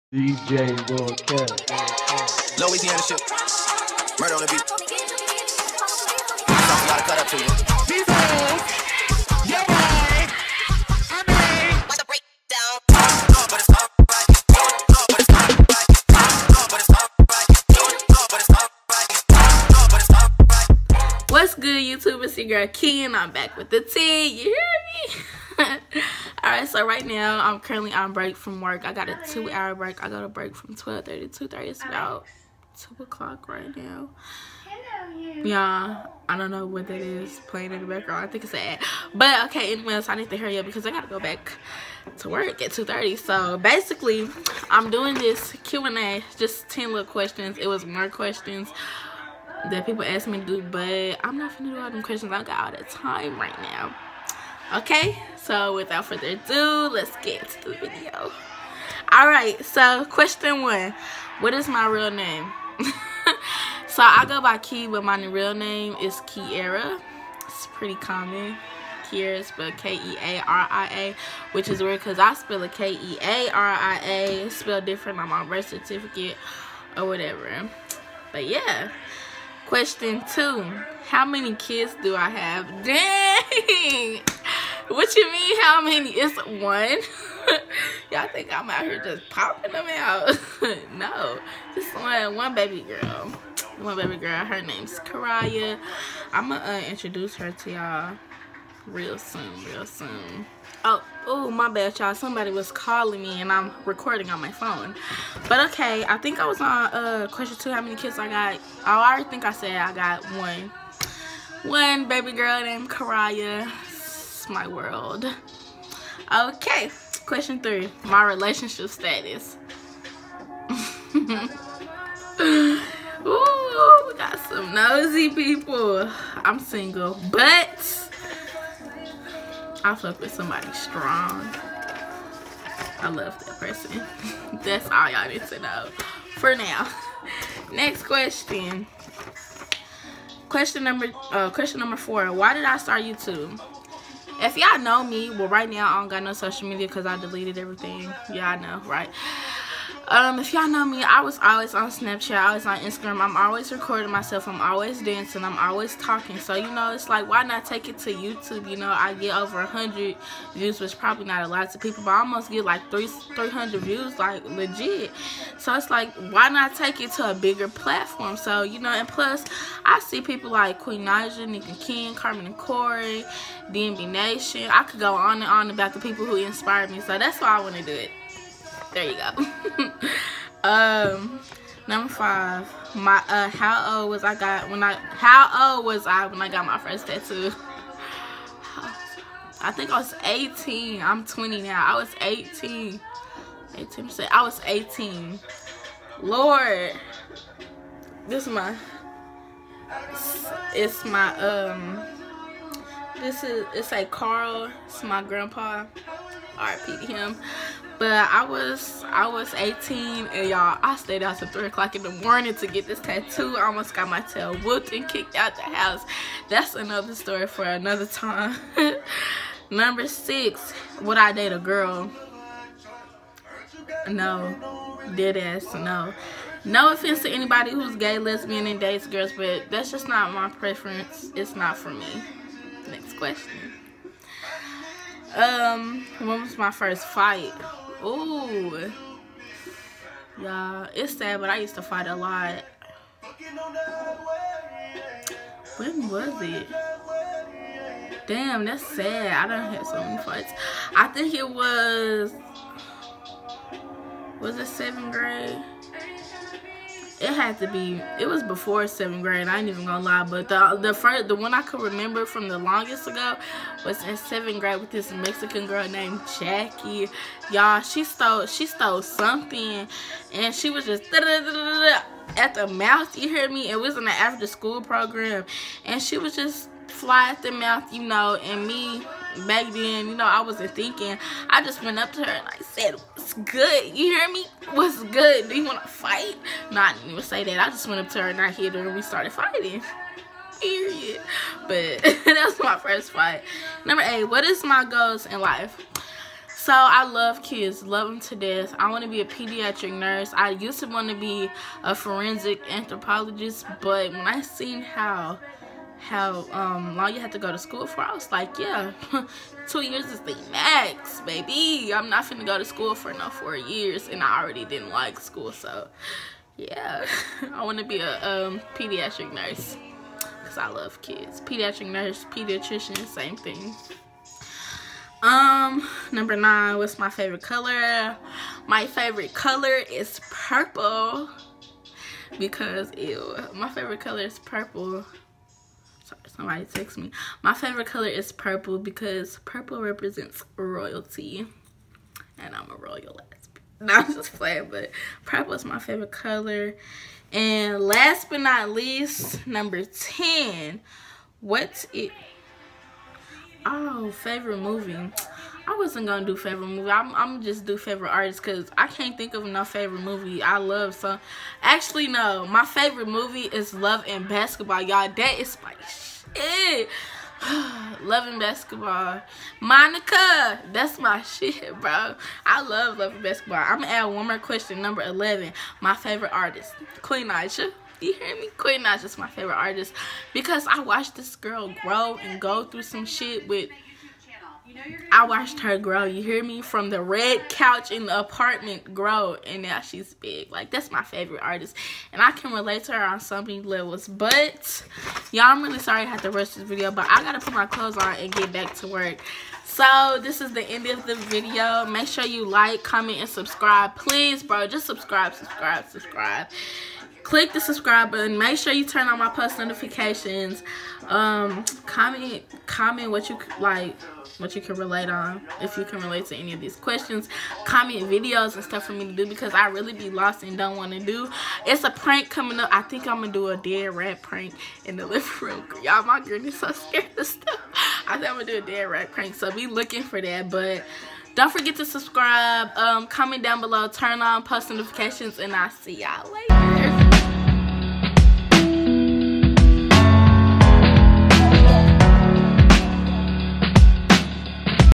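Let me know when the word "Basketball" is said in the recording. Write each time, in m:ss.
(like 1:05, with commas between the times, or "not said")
6:04, 6:08, 6:13.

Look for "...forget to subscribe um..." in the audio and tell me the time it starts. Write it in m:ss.
7:11.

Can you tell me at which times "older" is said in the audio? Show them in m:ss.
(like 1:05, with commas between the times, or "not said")
not said.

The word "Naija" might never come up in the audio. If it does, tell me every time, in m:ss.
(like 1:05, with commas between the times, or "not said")
2:51, 6:17.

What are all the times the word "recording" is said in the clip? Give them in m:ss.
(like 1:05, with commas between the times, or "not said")
1:43, 2:33.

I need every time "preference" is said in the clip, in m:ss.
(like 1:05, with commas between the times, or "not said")
3:50.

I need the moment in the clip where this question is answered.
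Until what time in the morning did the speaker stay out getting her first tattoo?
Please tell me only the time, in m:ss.
3:31.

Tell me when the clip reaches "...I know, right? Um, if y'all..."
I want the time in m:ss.
2:28.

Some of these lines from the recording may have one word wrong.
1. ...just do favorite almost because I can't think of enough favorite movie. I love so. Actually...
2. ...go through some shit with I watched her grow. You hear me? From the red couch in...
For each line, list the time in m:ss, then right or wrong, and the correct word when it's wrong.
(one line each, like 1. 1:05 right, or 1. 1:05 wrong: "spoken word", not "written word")
1. 5:57 wrong: "artist", not "almost"
2. 6:22 right.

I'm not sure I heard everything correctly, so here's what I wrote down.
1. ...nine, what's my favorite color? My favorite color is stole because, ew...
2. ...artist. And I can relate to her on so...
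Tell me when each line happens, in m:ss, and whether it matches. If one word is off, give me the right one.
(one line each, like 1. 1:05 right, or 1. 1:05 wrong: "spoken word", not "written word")
1. 5:26 wrong: "purple", not "stole"
2. 6:31 right.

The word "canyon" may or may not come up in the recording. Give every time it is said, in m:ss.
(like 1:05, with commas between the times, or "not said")
not said.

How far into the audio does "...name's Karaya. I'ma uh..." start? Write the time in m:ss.
1:34.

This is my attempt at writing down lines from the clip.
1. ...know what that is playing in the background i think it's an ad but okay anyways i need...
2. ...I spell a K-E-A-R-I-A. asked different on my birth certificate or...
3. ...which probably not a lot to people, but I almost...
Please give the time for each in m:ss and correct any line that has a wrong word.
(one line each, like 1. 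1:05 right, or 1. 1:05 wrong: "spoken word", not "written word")
1. 0:36 right
2. 1:12 wrong: "spelled", not "asked"
3. 2:40 right.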